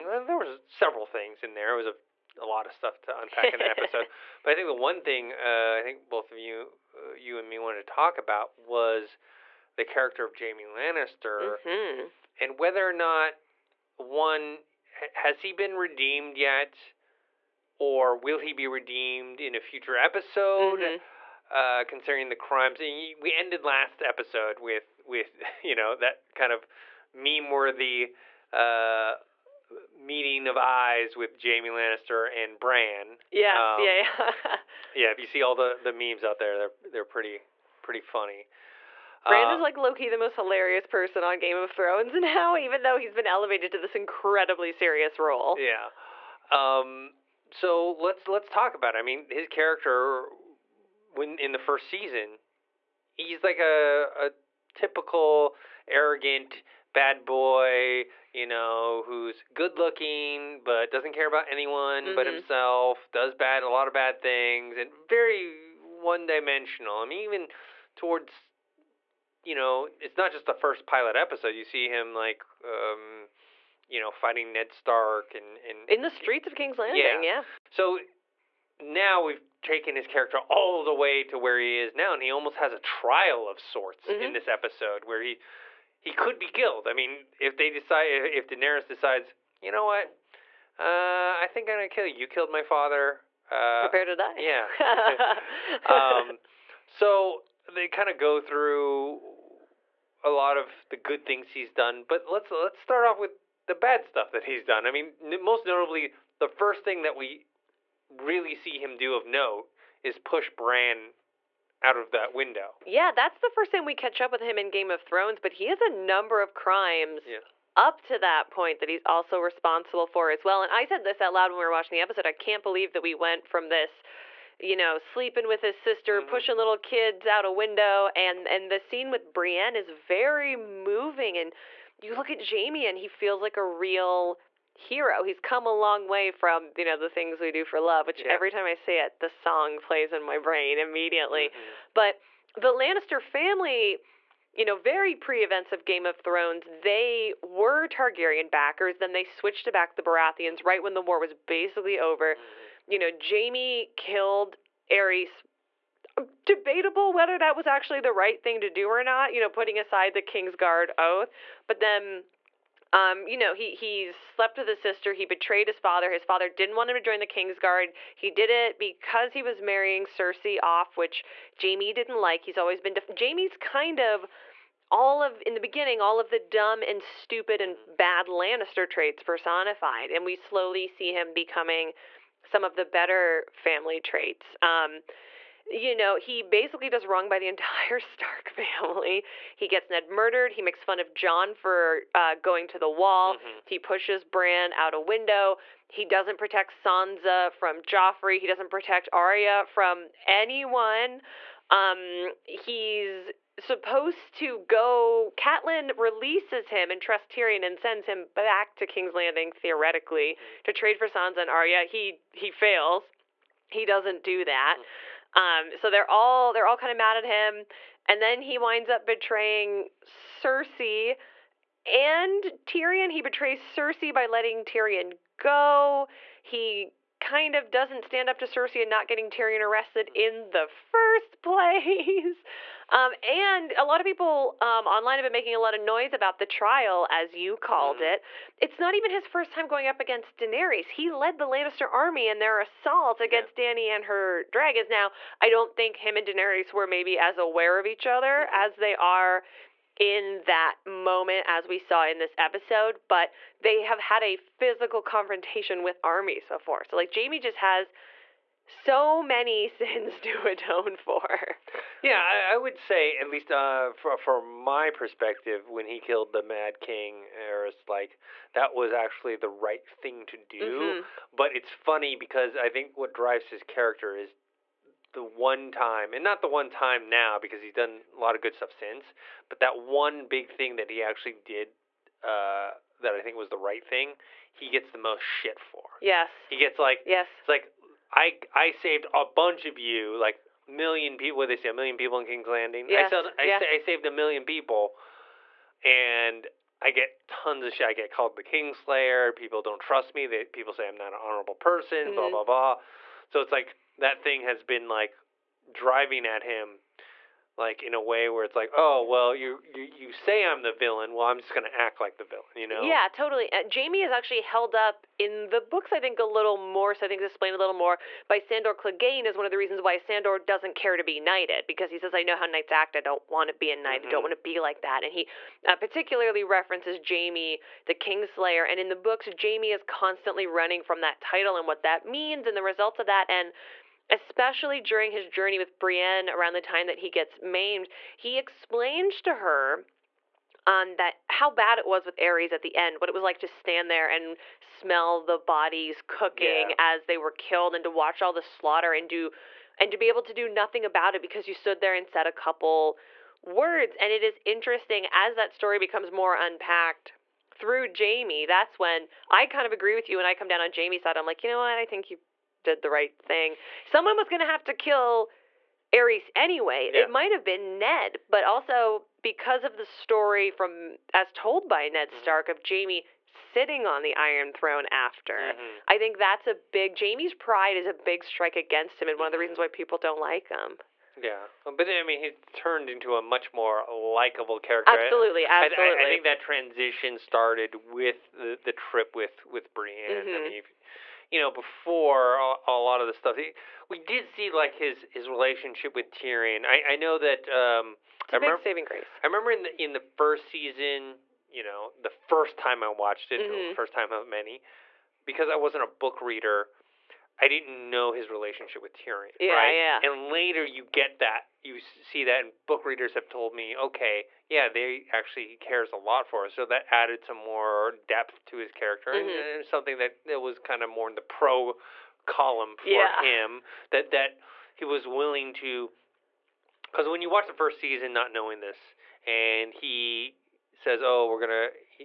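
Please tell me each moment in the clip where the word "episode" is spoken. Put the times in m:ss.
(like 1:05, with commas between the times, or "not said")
0:03, 0:19, 0:24, 1:11, 1:24, 2:02, 4:12.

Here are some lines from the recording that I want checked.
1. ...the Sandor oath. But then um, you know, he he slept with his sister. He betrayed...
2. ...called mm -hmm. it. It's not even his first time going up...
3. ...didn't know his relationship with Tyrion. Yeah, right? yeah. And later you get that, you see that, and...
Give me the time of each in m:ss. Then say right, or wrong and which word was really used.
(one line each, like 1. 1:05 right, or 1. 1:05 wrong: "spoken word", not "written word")
1. 2:40 wrong: "Kingsguard", not "Sandor"
2. 3:57 right
3. 6:47 right.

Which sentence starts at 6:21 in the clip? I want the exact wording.
Yeah, but I mean, he turned into a much more likable character.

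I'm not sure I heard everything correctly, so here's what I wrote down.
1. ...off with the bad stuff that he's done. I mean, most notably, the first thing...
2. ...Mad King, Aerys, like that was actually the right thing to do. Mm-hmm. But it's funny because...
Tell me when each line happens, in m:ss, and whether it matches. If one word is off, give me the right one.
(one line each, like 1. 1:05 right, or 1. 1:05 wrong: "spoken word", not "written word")
1. 1:43 right
2. 4:26 right.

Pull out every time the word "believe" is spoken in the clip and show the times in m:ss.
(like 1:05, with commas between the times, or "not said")
2:02.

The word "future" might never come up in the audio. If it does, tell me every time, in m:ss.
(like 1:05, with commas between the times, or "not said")
0:19.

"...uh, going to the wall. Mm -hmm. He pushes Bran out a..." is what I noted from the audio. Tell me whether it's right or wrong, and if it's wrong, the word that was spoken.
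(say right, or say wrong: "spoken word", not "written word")
right.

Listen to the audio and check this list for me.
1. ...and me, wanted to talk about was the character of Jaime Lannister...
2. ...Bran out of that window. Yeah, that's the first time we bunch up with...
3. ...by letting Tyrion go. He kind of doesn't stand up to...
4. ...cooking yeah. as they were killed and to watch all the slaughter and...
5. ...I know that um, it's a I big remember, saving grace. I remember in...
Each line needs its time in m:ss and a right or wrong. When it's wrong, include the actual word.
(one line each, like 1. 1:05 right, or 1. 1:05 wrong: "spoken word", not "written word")
1. 0:07 right
2. 1:50 wrong: "catch", not "bunch"
3. 3:44 right
4. 5:46 right
5. 6:36 right.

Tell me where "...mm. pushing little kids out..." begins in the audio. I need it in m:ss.
2:06.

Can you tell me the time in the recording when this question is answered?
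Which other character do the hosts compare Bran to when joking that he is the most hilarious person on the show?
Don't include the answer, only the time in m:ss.
0:39.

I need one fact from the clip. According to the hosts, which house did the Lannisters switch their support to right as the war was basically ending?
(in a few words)
The Baratheons.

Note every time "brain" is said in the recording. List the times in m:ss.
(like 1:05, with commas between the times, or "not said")
2:20.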